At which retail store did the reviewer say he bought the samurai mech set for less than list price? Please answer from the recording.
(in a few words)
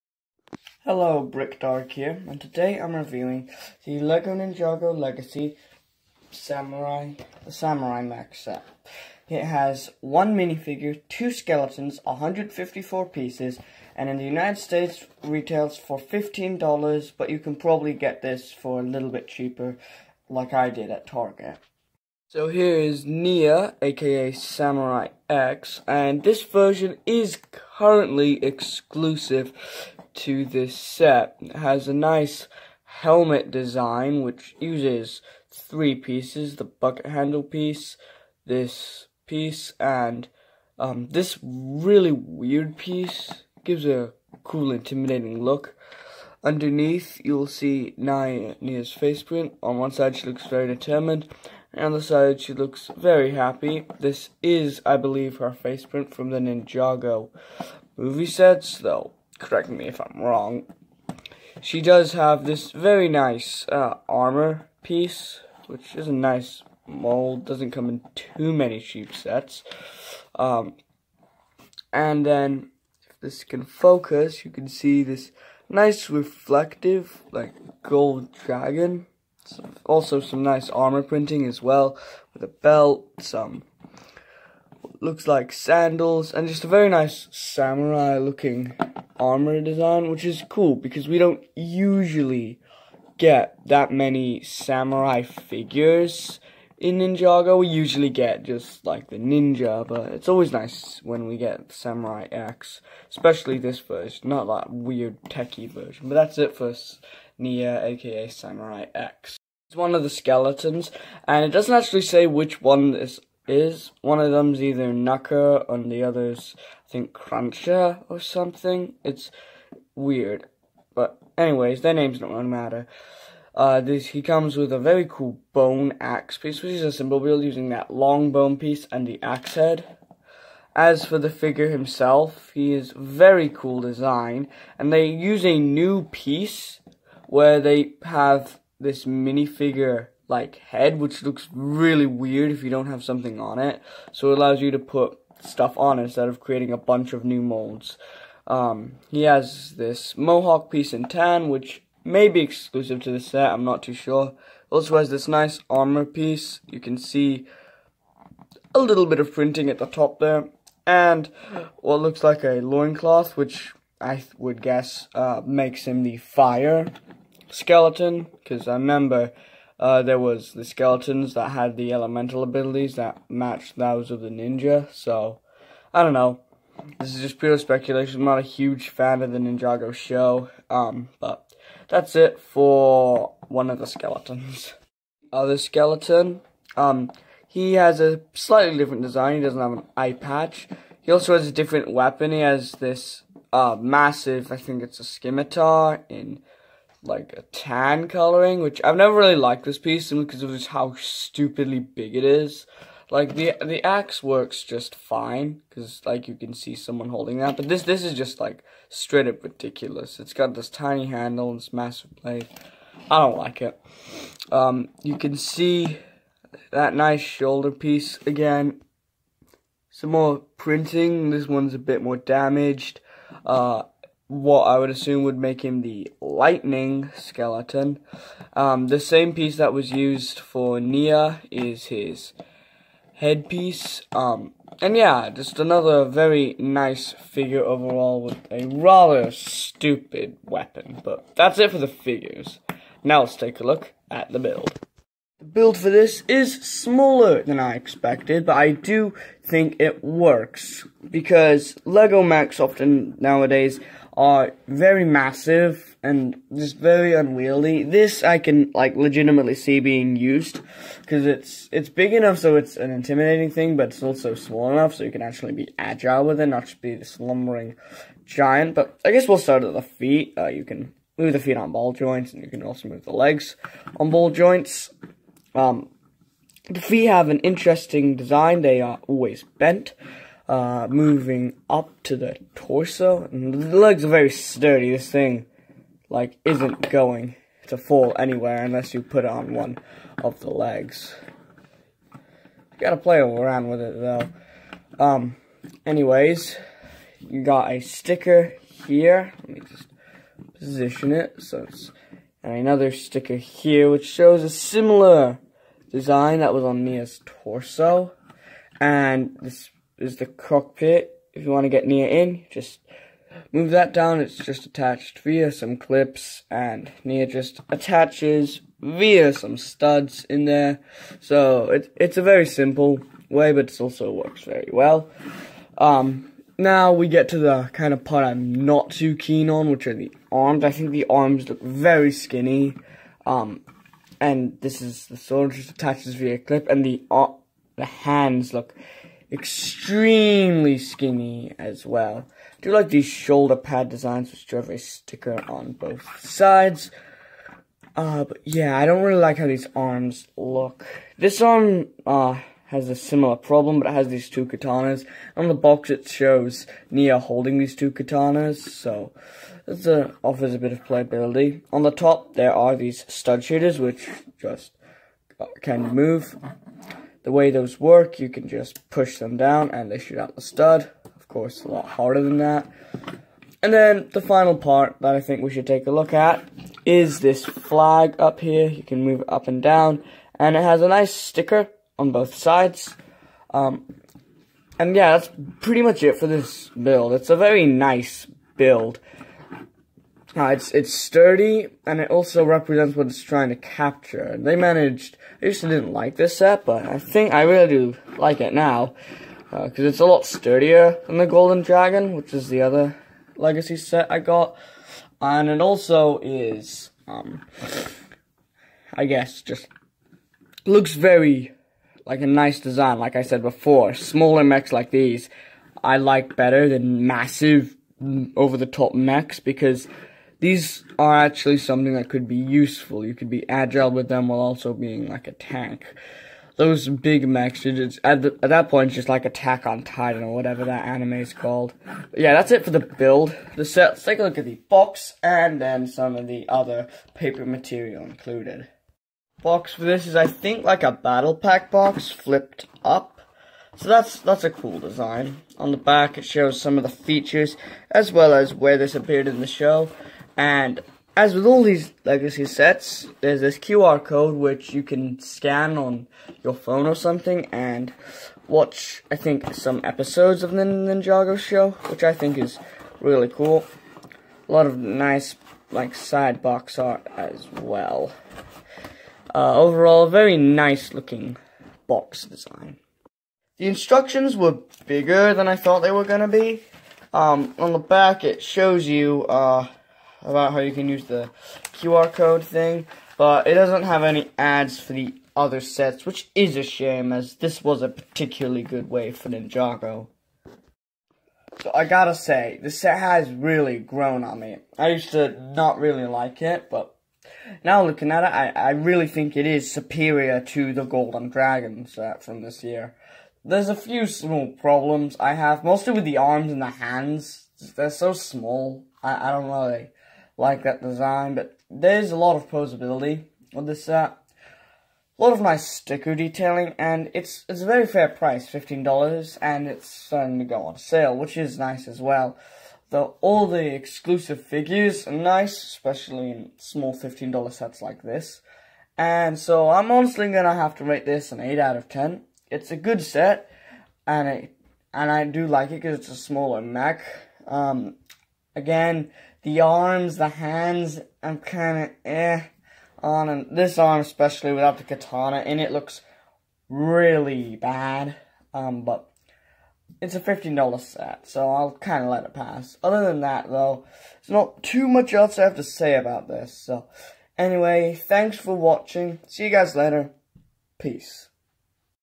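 Target.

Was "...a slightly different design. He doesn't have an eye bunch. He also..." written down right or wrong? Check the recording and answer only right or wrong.
wrong.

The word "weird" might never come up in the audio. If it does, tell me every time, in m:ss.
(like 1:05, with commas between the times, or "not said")
0:42, 1:44, 1:59, 2:22.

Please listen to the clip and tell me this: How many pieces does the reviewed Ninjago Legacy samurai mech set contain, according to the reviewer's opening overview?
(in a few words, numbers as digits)
154.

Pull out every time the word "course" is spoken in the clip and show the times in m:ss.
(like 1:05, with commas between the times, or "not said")
6:11.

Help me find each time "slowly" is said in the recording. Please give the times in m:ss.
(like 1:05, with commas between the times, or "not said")
not said.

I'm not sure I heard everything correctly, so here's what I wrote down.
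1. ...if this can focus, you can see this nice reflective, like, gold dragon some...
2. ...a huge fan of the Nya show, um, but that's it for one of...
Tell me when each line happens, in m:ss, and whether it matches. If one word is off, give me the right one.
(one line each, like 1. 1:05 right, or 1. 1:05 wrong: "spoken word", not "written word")
1. 1:13 right
2. 2:58 wrong: "Ninjago", not "Nya".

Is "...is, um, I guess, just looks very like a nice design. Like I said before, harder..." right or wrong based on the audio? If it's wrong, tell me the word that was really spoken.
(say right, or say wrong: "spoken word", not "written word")
wrong: "smaller", not "harder".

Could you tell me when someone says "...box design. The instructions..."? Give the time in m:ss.
7:51.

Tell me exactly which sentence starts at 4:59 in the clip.
Let me just position it so it's...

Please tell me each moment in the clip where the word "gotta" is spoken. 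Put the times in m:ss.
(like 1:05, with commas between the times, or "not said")
4:52, 8:11.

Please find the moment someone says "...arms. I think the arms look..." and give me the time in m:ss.
5:30.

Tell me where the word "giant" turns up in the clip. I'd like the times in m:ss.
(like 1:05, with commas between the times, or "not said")
4:28.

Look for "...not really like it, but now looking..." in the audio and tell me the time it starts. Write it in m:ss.
8:15.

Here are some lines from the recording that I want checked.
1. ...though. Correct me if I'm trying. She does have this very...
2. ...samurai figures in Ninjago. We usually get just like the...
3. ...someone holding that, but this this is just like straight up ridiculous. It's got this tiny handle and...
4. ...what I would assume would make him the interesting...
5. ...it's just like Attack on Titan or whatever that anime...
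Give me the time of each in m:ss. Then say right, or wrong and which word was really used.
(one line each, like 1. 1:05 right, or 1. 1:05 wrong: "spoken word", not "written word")
1. 0:58 wrong: "wrong", not "trying"
2. 1:34 right
3. 3:26 right
4. 3:44 wrong: "lightning", not "interesting"
5. 7:08 right.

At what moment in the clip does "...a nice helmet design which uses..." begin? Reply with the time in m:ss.
0:31.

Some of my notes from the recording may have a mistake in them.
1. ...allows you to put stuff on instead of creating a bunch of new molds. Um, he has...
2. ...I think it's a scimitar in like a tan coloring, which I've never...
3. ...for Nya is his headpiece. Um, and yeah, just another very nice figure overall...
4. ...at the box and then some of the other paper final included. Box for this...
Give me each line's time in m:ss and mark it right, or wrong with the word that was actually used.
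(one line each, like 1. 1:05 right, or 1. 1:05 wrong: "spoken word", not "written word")
1. 2:24 right
2. 3:14 right
3. 3:50 right
4. 7:14 wrong: "material", not "final".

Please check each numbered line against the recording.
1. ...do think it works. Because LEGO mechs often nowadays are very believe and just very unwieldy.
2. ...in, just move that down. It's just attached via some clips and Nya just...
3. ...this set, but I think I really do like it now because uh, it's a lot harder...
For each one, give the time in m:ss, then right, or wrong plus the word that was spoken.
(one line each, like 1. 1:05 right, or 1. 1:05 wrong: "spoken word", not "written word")
1. 4:08 wrong: "massive", not "believe"
2. 5:12 right
3. 6:36 wrong: "sturdier", not "harder".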